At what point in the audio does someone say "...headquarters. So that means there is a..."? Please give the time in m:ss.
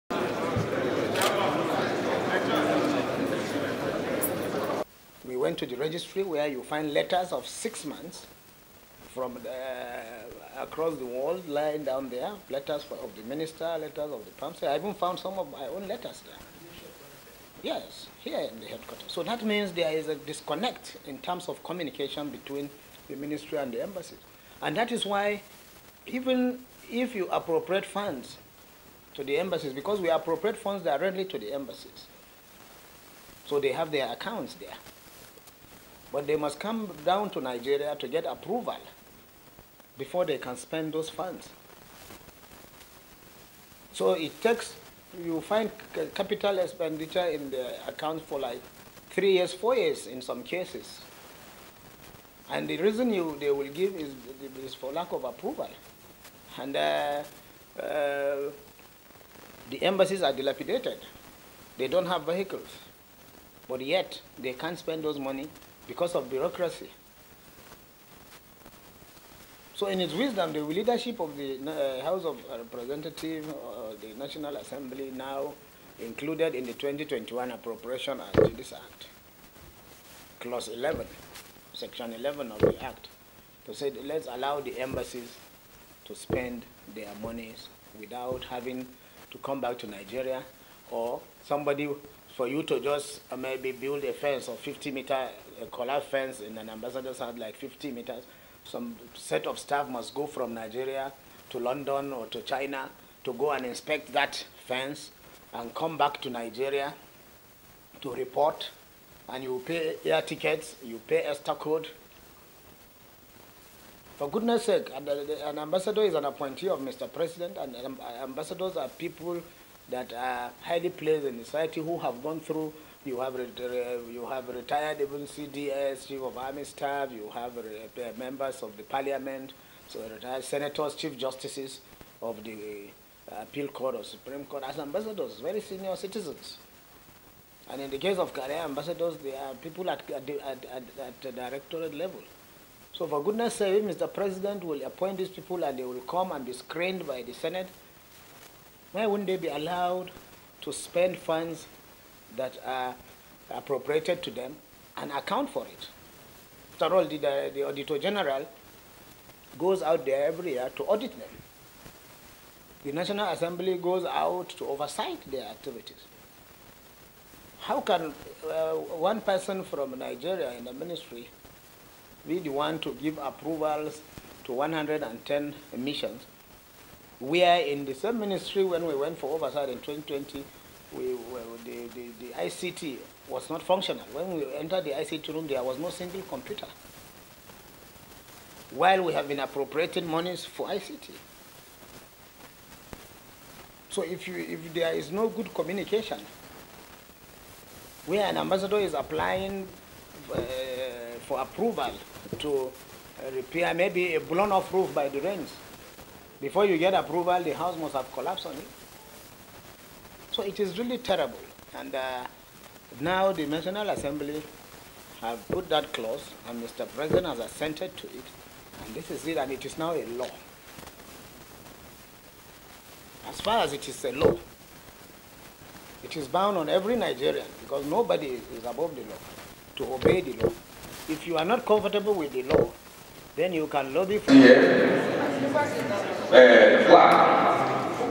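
0:18.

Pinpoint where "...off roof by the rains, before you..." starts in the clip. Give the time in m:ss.
3:24.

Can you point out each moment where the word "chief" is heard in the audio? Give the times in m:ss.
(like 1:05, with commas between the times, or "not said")
2:06, 2:10.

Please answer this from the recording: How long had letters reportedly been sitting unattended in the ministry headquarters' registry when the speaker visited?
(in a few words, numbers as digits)
6 months.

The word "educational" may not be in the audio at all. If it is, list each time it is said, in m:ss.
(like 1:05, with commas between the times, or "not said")
not said.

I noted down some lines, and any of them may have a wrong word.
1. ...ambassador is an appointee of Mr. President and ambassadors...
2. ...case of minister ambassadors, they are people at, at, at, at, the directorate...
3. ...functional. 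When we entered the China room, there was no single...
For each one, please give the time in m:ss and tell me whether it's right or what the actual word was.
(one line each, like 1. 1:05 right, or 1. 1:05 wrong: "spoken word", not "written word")
1. 1:55 right
2. 2:17 wrong: "career", not "minister"
3. 3:03 wrong: "ICT", not "China".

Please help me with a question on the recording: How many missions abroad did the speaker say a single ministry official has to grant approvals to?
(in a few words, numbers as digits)
110.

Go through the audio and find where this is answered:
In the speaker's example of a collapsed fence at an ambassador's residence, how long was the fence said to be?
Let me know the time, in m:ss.
1:34.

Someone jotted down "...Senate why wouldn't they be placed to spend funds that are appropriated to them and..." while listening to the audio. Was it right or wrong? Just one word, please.
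wrong.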